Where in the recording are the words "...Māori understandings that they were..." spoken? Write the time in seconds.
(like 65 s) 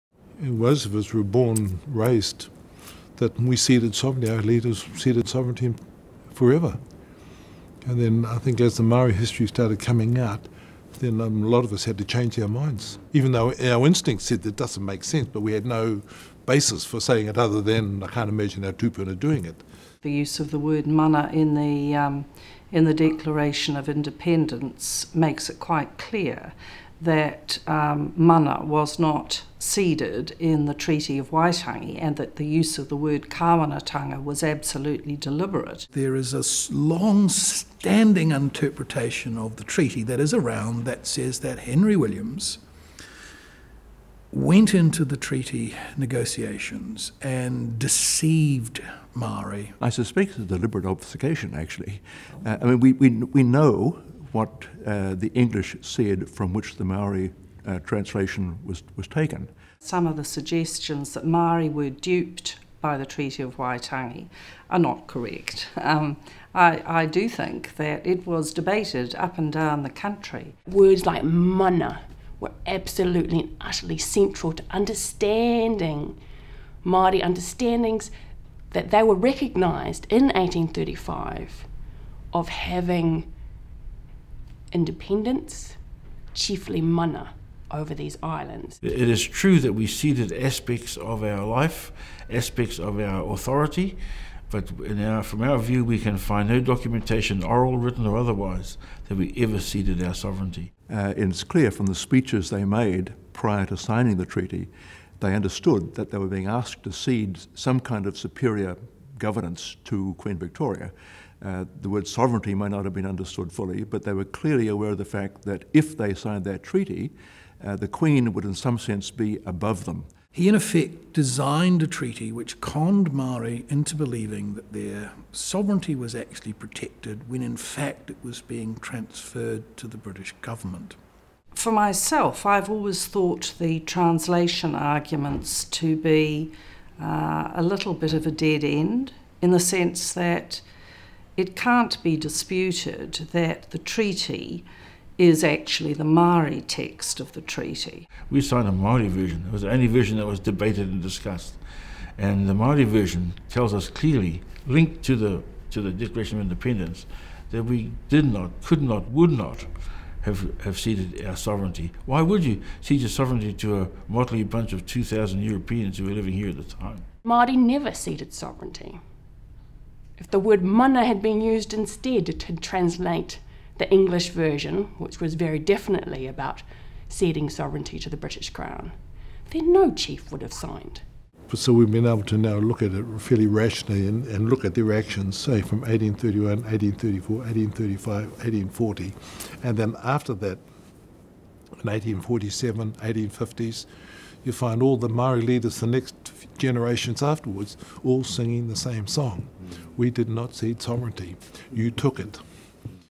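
76 s.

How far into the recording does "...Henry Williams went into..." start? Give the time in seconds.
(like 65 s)
41 s.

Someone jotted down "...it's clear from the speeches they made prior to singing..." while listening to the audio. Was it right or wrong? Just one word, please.
wrong.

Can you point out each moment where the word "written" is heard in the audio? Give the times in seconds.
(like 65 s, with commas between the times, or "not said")
97 s.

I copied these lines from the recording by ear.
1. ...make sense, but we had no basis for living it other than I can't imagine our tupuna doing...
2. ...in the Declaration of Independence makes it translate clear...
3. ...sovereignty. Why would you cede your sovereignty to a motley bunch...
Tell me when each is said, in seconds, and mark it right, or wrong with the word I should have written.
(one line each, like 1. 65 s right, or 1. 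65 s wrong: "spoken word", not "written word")
1. 14 s wrong: "saying", not "living"
2. 22 s wrong: "quite", not "translate"
3. 161 s right.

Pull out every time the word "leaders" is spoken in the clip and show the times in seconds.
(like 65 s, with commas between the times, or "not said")
4 s, 195 s.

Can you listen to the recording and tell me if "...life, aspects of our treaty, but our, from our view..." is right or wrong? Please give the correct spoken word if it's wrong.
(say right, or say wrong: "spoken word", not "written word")
wrong: "authority", not "treaty".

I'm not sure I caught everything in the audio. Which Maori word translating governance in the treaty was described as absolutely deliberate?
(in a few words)
kāwanatanga.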